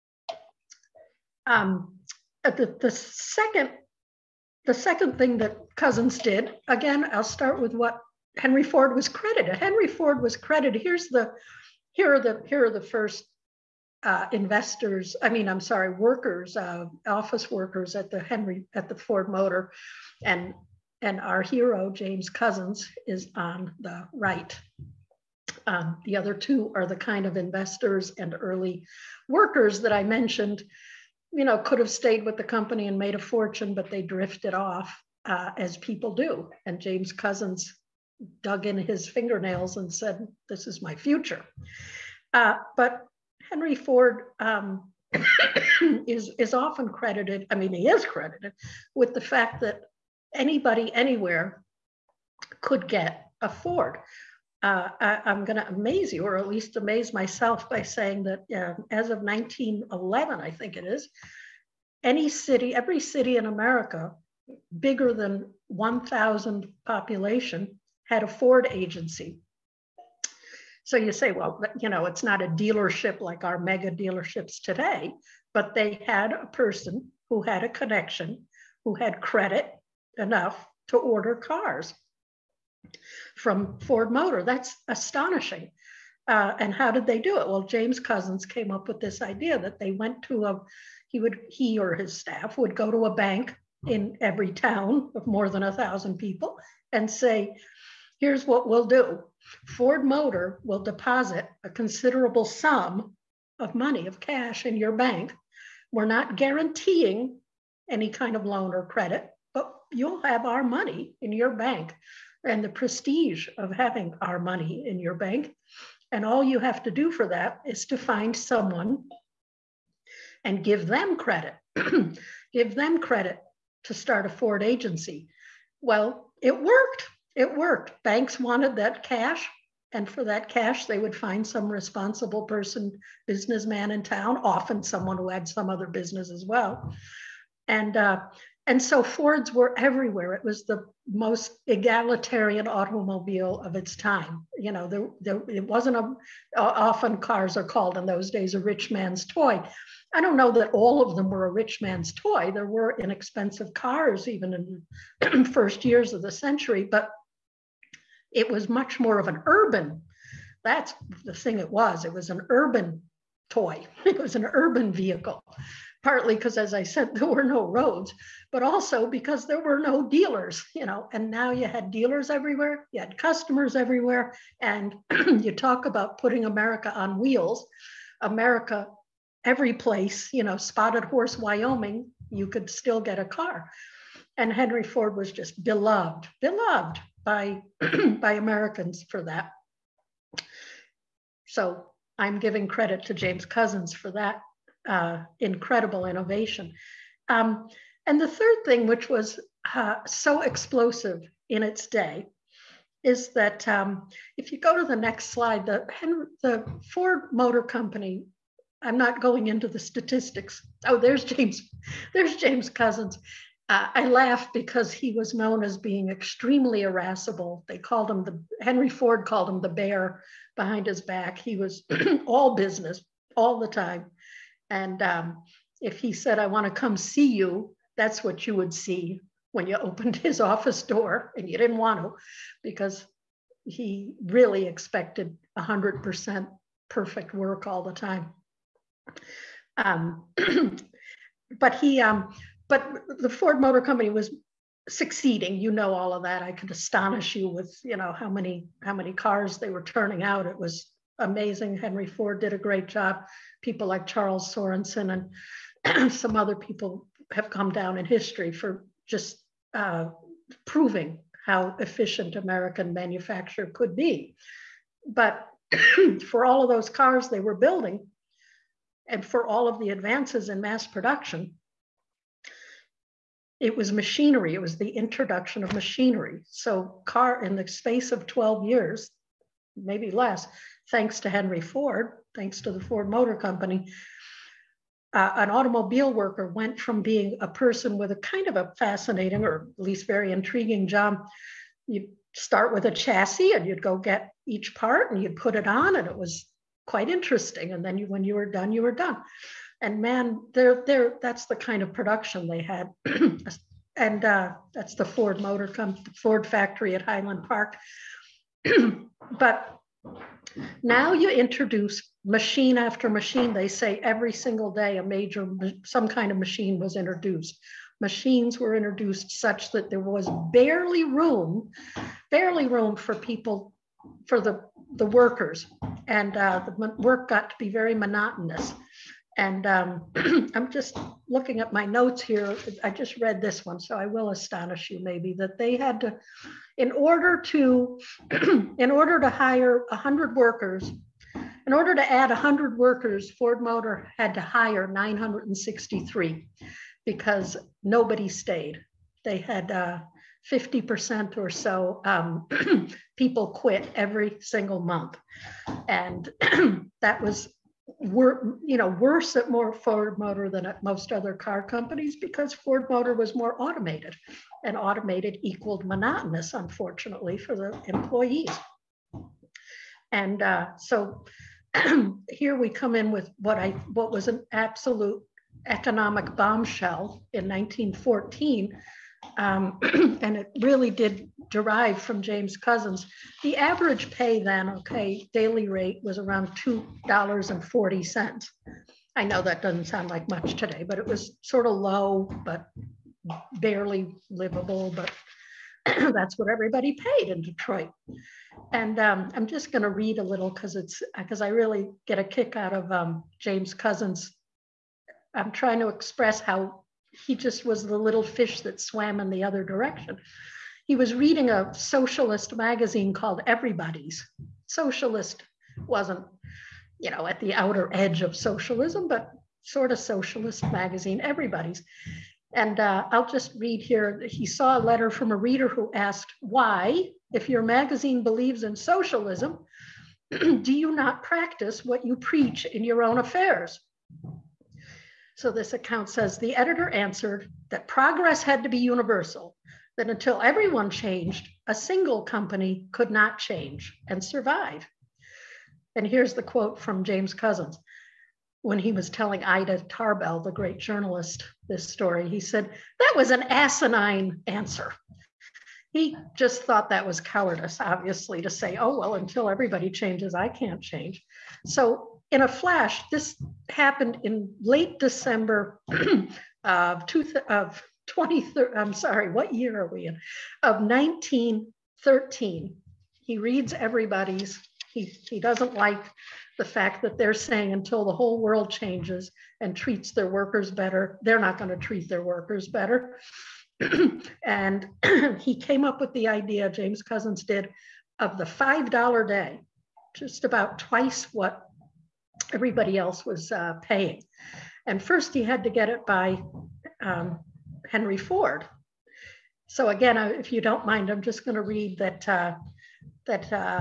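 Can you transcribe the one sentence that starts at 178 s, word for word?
America every place, you know, Spotted Horse, Wyoming, you could still get a car.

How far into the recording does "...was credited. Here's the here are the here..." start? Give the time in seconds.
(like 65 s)
10 s.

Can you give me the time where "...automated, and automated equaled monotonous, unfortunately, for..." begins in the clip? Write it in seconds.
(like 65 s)
363 s.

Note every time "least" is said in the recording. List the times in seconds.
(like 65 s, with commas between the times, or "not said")
56 s, 289 s.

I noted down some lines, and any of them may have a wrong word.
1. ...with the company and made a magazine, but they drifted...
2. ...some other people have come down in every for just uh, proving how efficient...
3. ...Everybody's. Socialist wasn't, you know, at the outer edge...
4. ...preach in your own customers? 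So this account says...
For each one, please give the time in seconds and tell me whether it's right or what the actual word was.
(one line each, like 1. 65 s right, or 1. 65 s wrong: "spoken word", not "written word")
1. 32 s wrong: "fortune", not "magazine"
2. 256 s wrong: "history", not "every"
3. 413 s right
4. 432 s wrong: "affairs", not "customers".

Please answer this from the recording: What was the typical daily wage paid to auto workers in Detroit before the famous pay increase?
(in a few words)
$2.40.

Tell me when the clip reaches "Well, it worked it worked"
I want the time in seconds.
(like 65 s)
125 s.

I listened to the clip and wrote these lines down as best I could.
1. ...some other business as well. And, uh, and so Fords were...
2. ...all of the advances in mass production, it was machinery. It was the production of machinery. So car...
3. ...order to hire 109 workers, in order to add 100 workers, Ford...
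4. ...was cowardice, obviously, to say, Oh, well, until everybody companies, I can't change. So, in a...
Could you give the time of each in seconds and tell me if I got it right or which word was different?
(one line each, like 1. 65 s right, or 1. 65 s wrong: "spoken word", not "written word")
1. 135 s right
2. 269 s wrong: "introduction", not "production"
3. 338 s wrong: "100", not "109"
4. 457 s wrong: "changes", not "companies".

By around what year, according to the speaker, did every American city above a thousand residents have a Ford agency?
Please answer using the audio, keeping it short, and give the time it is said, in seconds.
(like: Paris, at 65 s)
1911, at 59 s.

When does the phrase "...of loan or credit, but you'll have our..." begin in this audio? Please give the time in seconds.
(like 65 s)
108 s.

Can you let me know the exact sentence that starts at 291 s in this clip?
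You start with a chassis and you'd go get each part and you'd put it on and it was quite interesting.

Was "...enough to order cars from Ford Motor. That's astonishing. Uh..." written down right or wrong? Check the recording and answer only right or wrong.
right.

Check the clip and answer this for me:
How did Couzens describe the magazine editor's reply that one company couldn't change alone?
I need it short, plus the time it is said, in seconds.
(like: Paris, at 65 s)
asinine, at 453 s.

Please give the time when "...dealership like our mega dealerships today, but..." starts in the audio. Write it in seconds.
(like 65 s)
72 s.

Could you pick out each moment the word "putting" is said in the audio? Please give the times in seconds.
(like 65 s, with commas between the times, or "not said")
176 s.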